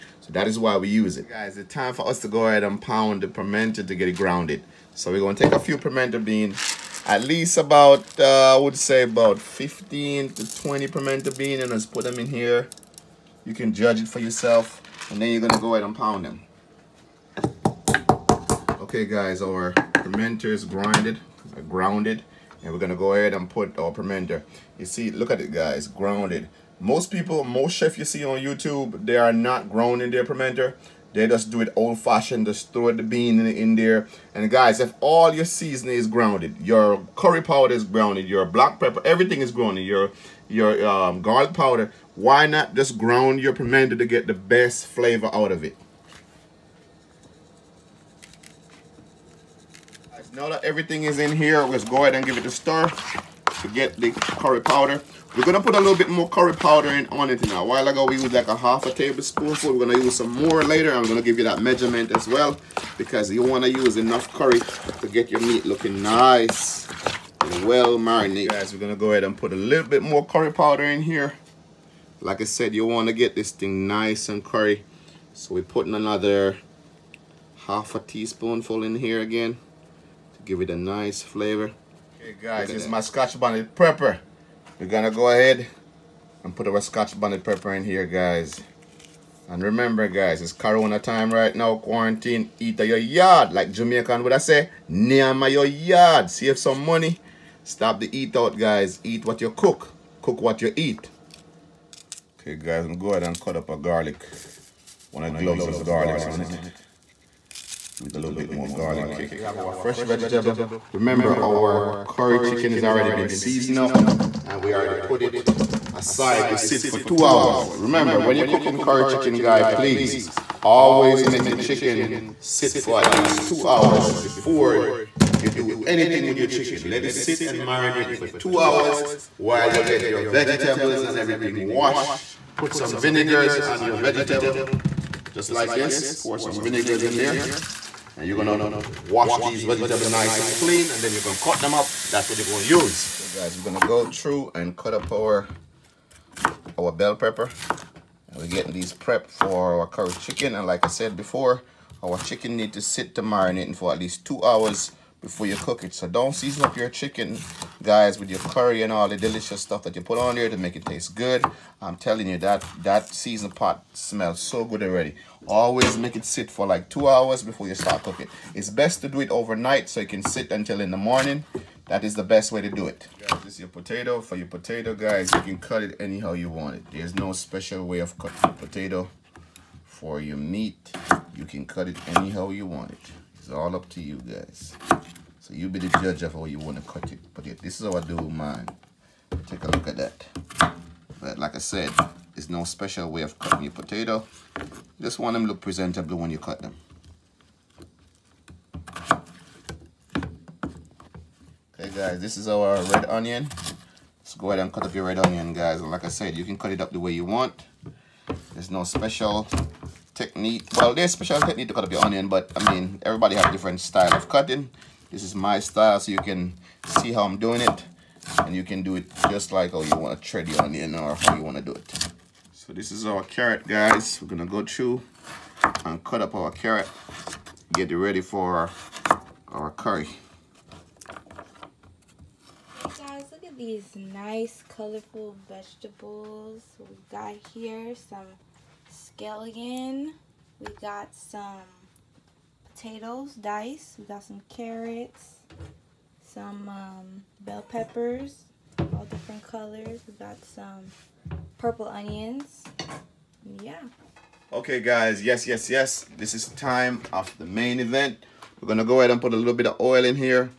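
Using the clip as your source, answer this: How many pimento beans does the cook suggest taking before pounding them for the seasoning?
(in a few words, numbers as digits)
15 to 20.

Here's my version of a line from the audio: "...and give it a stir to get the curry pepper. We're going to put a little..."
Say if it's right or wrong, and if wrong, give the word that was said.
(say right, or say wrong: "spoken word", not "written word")
wrong: "powder", not "pepper".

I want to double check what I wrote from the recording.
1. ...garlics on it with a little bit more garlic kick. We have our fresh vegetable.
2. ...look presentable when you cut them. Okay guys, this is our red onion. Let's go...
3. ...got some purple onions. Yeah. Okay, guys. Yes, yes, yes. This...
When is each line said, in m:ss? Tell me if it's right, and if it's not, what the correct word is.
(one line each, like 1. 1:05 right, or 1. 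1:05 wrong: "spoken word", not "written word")
1. 1:45 right
2. 3:15 right
3. 4:10 right.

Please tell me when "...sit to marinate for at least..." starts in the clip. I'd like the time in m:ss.
2:32.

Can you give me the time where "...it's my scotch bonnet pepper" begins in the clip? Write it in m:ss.
1:22.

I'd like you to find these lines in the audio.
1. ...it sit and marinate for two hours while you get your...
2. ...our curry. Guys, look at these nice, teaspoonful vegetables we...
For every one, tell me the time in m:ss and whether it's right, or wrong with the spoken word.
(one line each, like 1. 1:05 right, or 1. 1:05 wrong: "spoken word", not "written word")
1. 2:07 right
2. 3:49 wrong: "colorful", not "teaspoonful".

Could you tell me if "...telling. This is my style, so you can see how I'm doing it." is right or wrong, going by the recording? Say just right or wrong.
wrong.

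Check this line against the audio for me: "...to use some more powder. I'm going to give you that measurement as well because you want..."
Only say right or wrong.
wrong.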